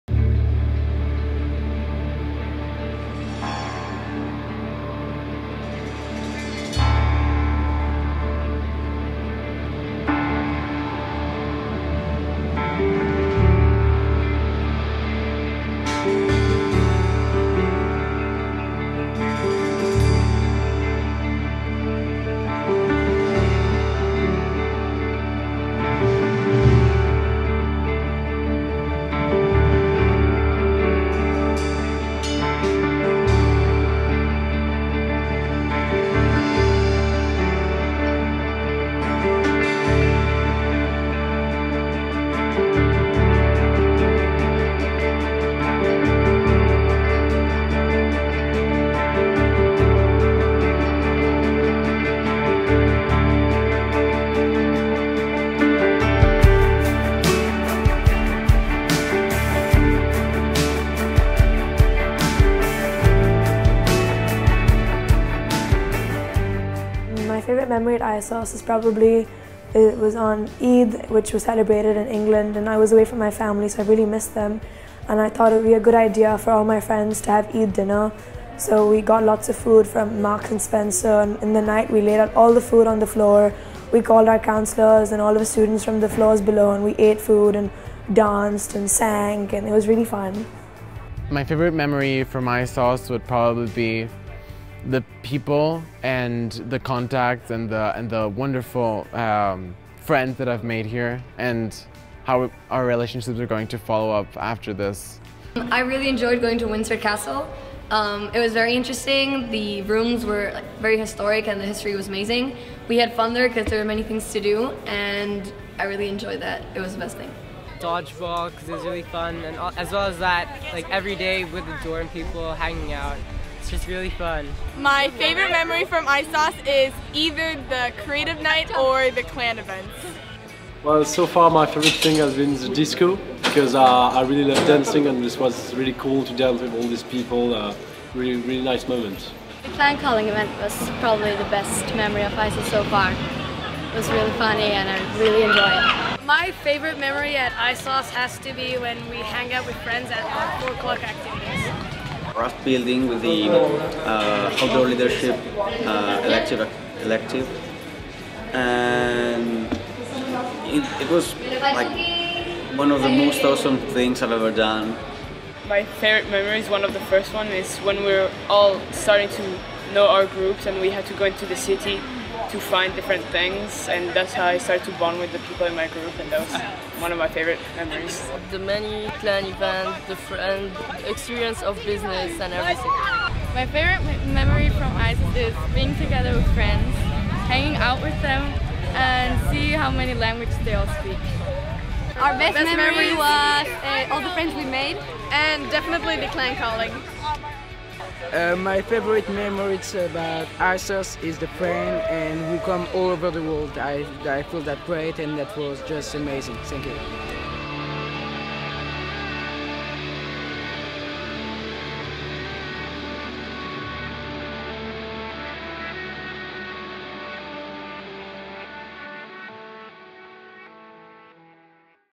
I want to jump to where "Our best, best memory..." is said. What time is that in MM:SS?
03:12.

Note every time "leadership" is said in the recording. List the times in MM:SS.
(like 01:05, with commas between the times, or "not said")
02:34.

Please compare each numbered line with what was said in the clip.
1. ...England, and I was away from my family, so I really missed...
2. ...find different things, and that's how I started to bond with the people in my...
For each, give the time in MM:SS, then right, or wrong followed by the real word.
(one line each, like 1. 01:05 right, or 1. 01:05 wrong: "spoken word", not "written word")
1. 01:12 right
2. 02:52 right.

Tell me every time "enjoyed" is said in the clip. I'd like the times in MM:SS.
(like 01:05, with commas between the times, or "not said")
01:46, 01:56, 02:25.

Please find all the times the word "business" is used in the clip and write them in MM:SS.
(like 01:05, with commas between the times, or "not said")
03:01.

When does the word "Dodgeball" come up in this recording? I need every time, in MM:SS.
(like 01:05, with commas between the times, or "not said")
01:57.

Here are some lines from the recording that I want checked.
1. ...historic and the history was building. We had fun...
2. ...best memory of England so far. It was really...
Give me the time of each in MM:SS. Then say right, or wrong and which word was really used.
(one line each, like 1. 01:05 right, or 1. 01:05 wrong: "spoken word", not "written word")
1. 01:50 wrong: "amazing", not "building"
2. 02:21 wrong: "ISSOS", not "England".